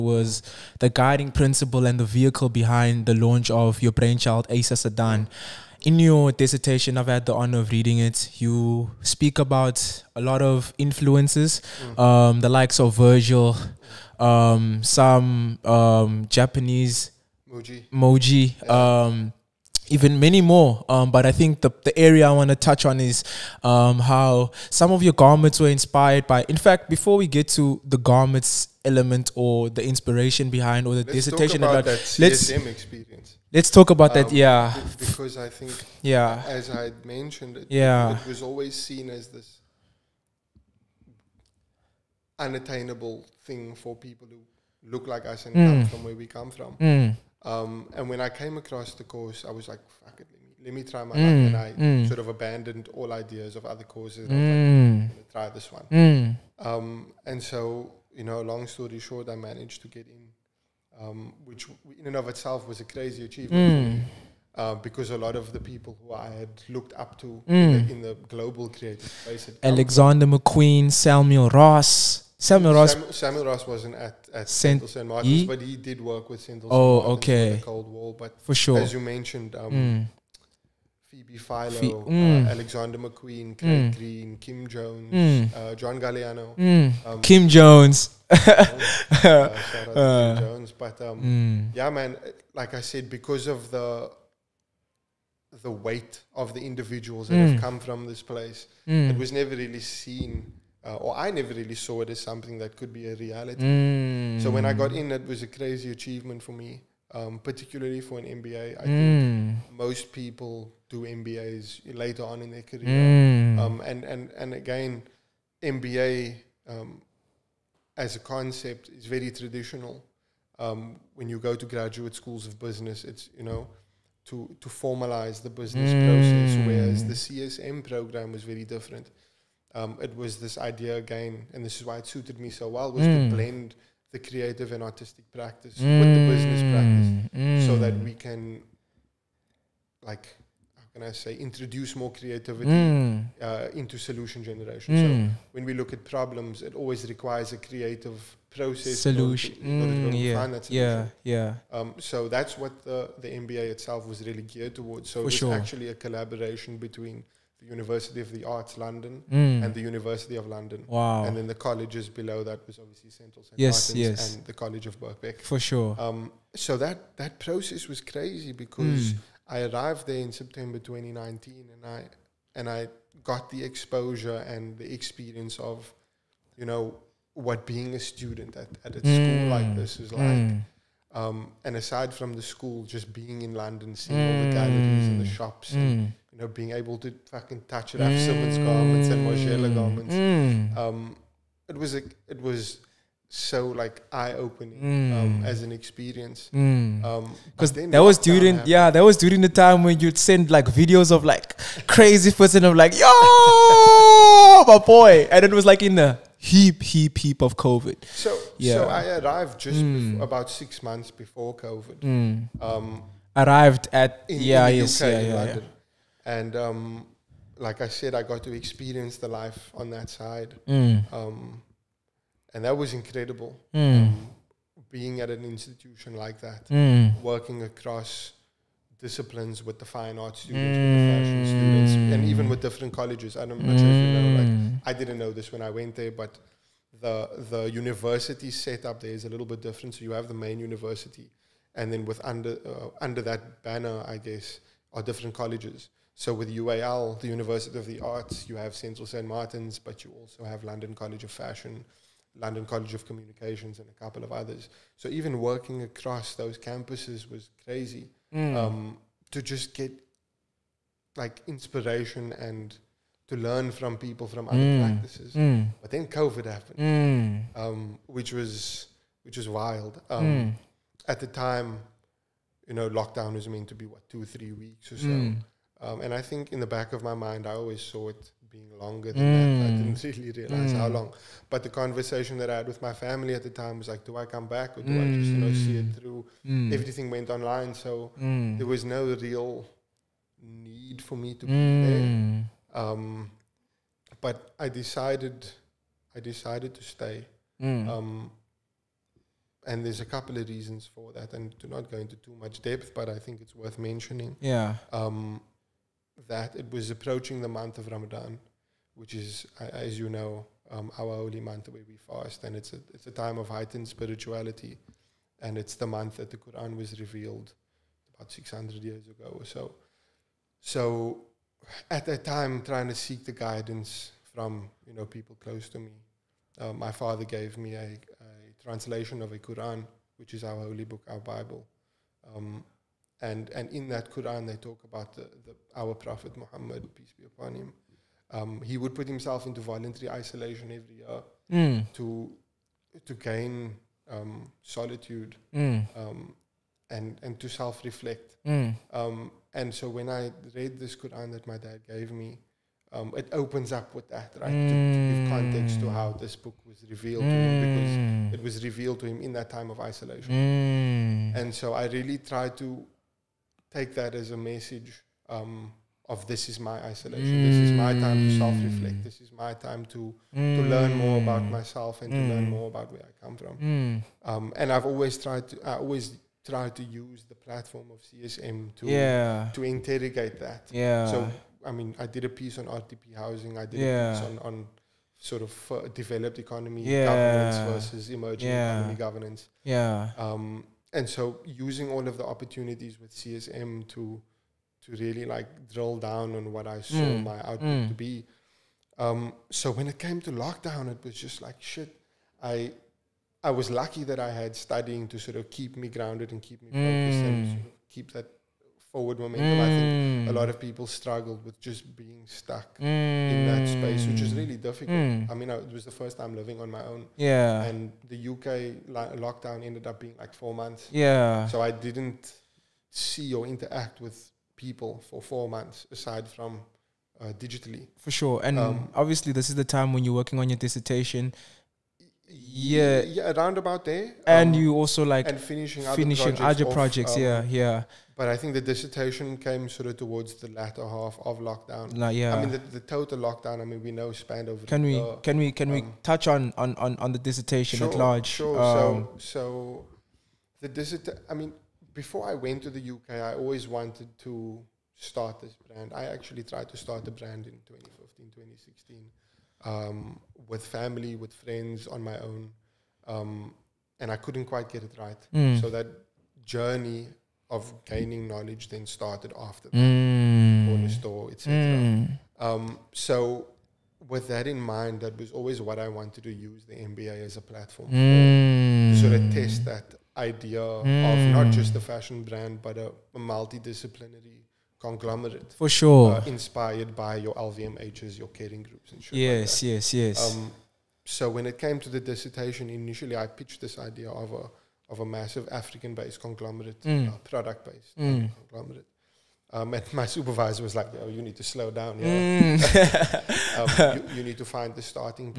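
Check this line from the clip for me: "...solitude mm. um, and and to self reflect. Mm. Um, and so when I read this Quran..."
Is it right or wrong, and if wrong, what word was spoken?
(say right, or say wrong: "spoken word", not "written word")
right.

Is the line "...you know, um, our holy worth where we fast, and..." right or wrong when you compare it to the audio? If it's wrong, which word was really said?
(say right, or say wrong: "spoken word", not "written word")
wrong: "month", not "worth".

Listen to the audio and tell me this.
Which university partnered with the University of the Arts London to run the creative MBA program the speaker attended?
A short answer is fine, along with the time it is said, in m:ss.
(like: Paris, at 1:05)
University of London, at 2:39.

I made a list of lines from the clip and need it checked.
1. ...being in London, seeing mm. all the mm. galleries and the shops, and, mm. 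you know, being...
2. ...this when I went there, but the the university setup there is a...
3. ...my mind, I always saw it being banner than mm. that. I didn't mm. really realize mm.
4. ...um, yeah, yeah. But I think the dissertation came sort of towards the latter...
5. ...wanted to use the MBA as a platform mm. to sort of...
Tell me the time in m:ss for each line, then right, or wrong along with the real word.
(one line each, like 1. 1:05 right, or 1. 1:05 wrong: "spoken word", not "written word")
1. 3:03 right
2. 3:55 right
3. 4:37 wrong: "longer", not "banner"
4. 7:17 right
5. 7:55 right.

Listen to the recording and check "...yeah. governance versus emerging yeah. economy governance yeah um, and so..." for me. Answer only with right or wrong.
right.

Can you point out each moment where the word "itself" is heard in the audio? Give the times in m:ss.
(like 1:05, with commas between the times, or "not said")
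1:02, 2:33.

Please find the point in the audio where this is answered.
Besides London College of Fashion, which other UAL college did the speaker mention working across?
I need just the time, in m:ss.
4:12.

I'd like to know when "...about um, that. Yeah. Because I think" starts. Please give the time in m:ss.
0:33.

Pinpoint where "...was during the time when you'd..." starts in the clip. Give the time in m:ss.
3:19.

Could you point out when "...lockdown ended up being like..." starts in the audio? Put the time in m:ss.
6:59.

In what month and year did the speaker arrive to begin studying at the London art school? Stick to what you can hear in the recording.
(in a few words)
September 2019.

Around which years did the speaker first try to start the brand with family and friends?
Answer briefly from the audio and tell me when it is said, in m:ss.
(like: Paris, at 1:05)
2015, 2016, at 7:37.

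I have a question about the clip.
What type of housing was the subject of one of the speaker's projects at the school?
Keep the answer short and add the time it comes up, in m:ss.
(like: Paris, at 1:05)
RDP housing, at 6:22.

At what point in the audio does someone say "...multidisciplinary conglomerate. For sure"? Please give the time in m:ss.
8:03.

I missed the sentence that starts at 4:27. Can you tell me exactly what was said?
um, which was which was wild.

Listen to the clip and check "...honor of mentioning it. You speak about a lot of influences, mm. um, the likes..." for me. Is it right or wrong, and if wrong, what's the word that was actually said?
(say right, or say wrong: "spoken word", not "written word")
wrong: "reading", not "mentioning".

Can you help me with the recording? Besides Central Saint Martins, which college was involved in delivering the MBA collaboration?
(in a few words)
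Birkbeck.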